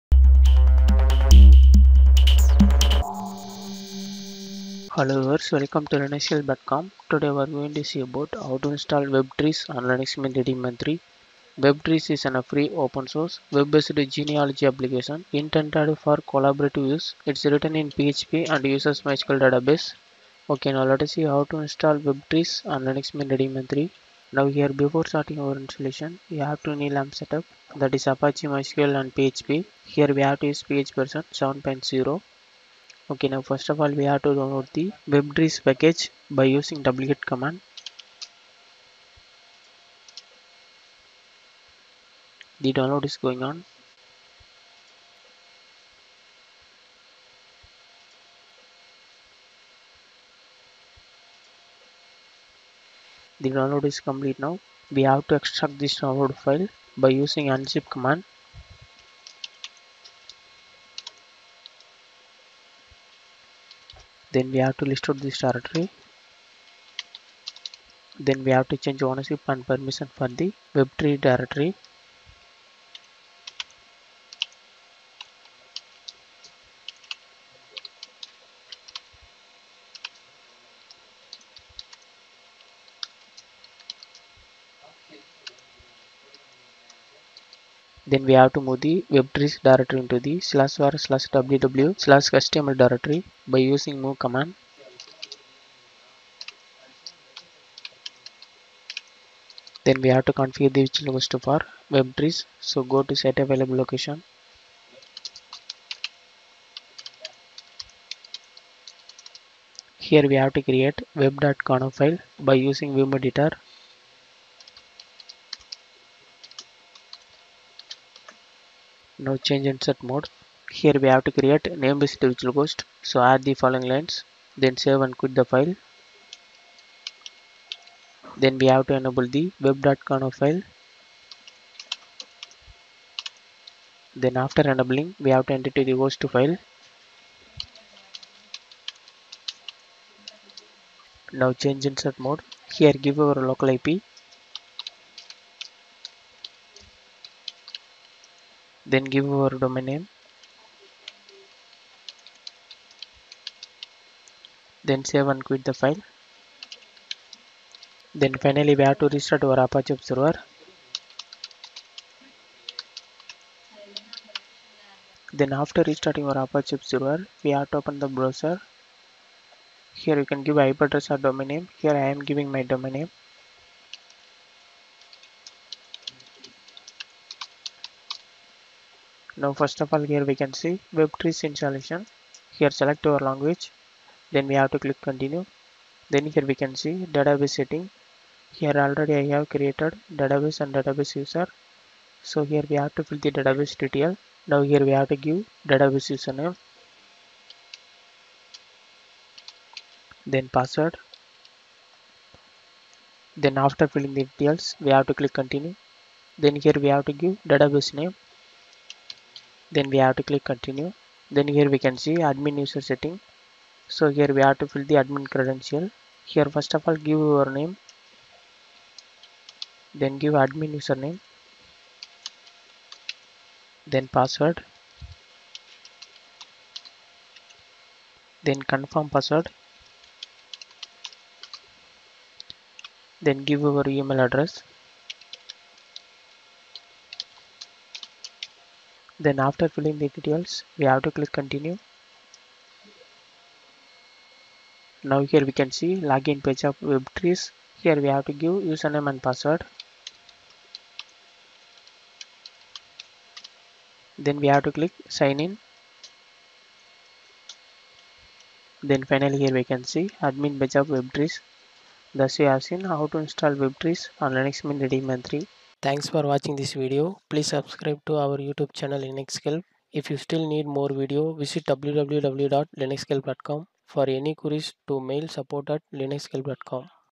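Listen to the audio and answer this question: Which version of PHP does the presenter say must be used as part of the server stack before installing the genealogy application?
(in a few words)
7.0.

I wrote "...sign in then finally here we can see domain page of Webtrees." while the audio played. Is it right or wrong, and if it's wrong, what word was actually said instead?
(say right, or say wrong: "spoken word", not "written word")
wrong: "admin", not "domain".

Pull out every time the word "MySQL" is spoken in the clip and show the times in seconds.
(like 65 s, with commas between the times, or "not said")
19 s, 28 s.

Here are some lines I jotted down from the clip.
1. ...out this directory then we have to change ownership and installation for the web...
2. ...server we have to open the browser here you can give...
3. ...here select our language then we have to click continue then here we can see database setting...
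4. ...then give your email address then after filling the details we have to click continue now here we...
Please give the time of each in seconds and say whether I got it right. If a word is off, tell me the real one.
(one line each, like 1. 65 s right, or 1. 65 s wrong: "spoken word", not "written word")
1. 65 s wrong: "permission", not "installation"
2. 166 s right
3. 182 s right
4. 233 s right.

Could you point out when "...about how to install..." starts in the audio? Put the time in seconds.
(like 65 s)
8 s.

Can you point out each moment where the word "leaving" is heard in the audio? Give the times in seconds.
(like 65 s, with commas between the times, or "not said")
not said.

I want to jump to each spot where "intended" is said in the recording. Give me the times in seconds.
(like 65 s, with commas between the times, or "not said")
15 s.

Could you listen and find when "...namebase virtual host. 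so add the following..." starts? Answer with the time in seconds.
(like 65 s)
121 s.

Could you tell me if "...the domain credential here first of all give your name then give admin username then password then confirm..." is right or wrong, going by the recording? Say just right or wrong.
wrong.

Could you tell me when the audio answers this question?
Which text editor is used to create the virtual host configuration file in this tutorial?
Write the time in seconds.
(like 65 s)
112 s.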